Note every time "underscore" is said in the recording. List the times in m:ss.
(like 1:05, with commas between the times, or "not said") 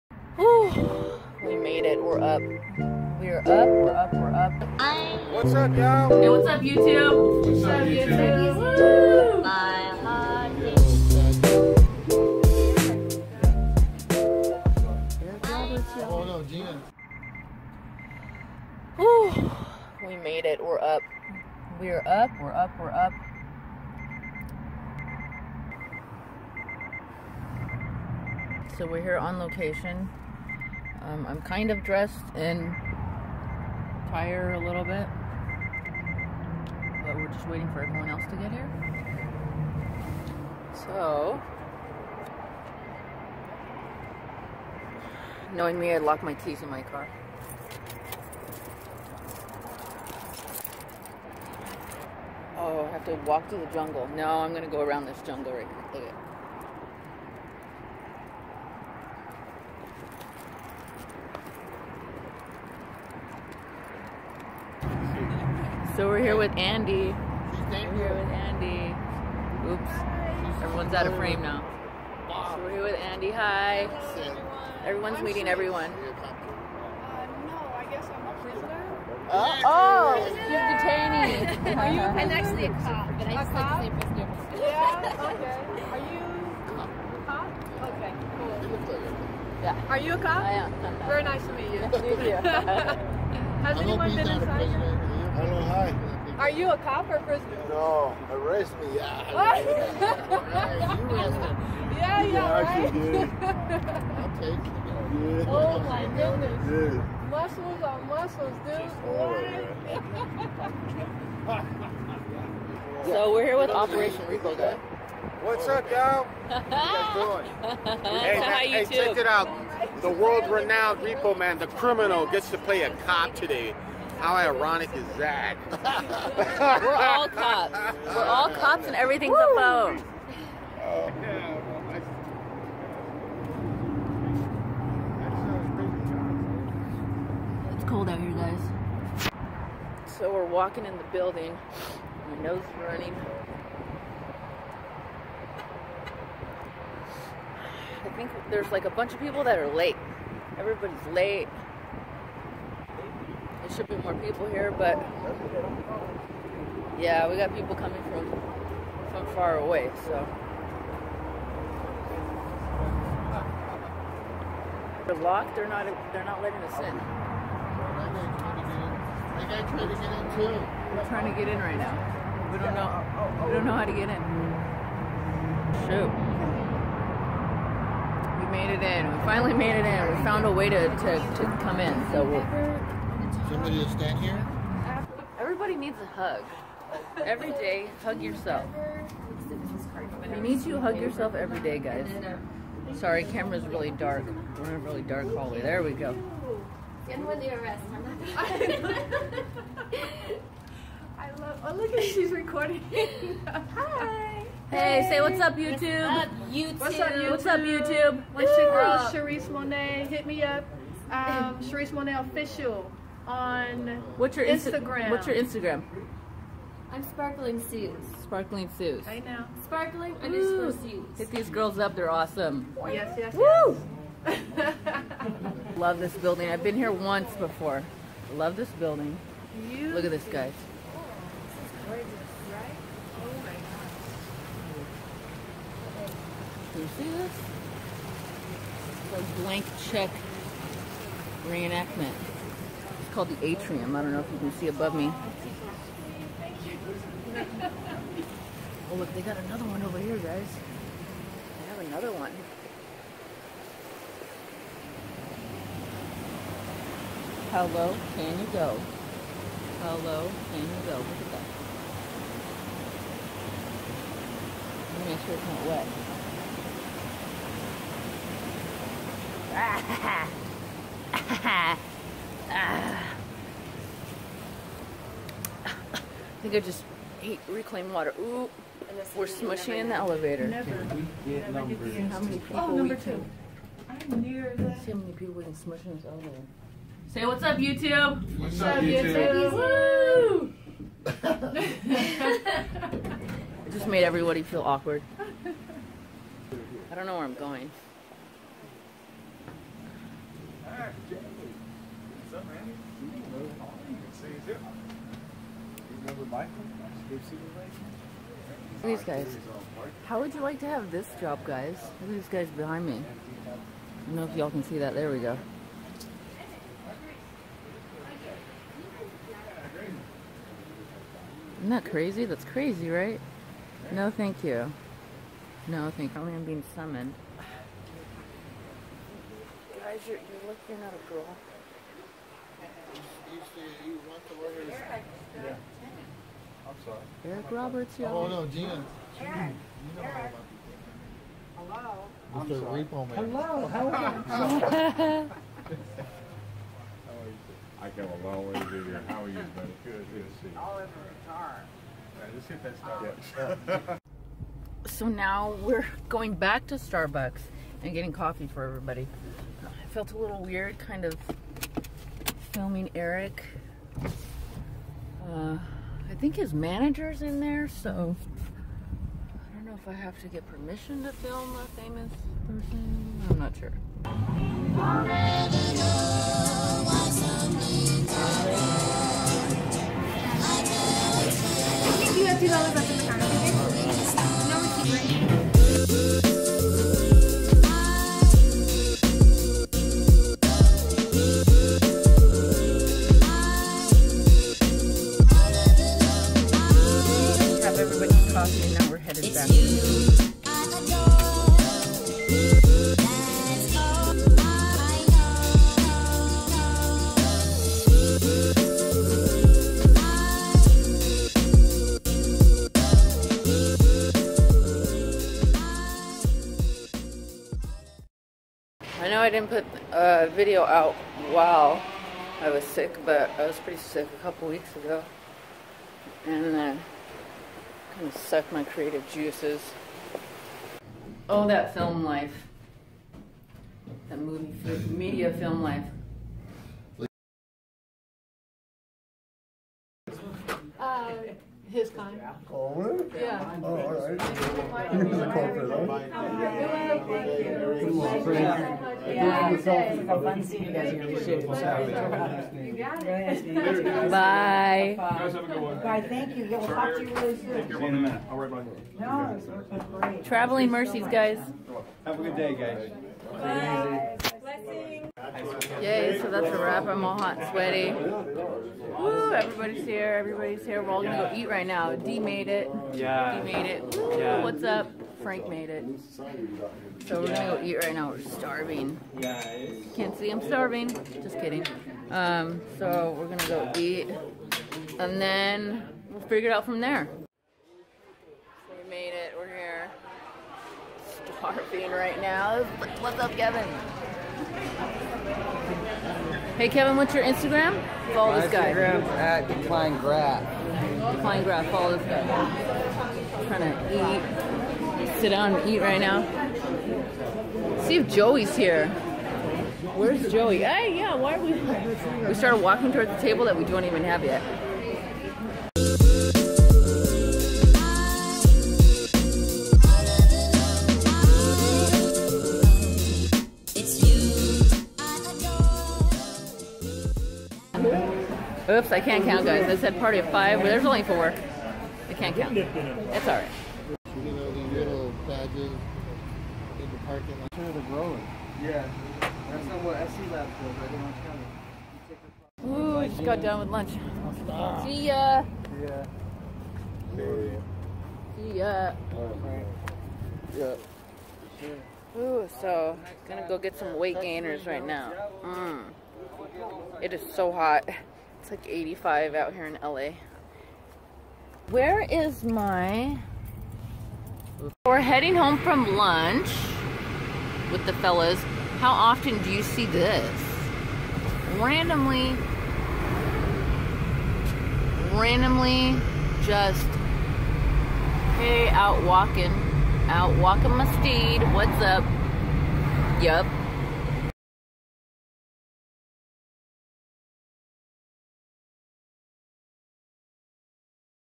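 3:40.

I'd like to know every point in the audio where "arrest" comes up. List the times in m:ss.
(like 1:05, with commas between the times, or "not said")
1:38, 3:17.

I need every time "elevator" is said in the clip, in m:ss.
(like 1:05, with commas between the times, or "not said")
4:39, 4:46.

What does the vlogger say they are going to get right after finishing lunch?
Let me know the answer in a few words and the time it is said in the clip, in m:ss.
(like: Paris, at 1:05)
Weight gainers, at 9:13.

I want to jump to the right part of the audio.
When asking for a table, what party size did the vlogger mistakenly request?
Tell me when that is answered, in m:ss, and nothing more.
8:50.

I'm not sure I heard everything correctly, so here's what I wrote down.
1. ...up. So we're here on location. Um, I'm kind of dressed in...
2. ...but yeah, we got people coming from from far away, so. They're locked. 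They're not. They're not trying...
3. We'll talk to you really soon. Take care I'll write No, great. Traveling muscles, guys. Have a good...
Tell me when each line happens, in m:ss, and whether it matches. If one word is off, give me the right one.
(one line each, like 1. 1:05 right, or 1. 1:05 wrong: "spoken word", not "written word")
1. 0:22 right
2. 2:34 wrong: "letting", not "trying"
3. 7:36 wrong: "mercies", not "muscles".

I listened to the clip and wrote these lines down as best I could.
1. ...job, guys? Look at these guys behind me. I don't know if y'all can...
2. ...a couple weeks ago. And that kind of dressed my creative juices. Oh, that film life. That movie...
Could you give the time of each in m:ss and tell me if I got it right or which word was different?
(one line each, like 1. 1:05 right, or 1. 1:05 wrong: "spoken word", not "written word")
1. 5:11 right
2. 7:04 wrong: "sucked", not "dressed".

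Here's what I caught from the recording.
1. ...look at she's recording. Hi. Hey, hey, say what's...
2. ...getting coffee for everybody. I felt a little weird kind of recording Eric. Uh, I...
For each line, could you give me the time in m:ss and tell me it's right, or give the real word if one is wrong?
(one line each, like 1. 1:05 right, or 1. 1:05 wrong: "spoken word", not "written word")
1. 3:21 right
2. 5:57 wrong: "filming", not "recording".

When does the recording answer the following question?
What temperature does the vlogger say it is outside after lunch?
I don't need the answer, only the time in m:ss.
9:18.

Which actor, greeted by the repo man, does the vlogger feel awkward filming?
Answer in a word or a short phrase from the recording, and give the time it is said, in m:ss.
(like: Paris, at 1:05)
Eric Roberts, at 5:37.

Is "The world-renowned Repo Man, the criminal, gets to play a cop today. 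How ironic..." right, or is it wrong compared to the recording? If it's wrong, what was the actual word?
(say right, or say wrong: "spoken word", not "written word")
right.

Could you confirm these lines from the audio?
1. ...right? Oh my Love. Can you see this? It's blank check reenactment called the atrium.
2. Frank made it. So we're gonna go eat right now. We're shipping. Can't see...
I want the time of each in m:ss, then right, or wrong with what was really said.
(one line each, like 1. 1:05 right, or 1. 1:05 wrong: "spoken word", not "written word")
1. 3:52 wrong: "God", not "Love"
2. 7:55 wrong: "starving", not "shipping".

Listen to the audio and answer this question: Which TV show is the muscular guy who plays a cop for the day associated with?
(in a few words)
Operation Repo.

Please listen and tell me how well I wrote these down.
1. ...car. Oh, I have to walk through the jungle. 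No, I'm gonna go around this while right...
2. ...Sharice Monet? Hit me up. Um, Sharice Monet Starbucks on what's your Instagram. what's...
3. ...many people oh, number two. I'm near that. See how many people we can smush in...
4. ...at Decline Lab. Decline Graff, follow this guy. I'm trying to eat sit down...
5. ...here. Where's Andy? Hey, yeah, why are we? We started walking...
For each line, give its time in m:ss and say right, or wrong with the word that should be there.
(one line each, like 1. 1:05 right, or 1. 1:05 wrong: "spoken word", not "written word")
1. 0:46 wrong: "jungle", not "while"
2. 3:29 wrong: "Official", not "Starbucks"
3. 4:42 right
4. 8:19 wrong: "Graff", not "Lab"
5. 8:28 wrong: "Joey", not "Andy".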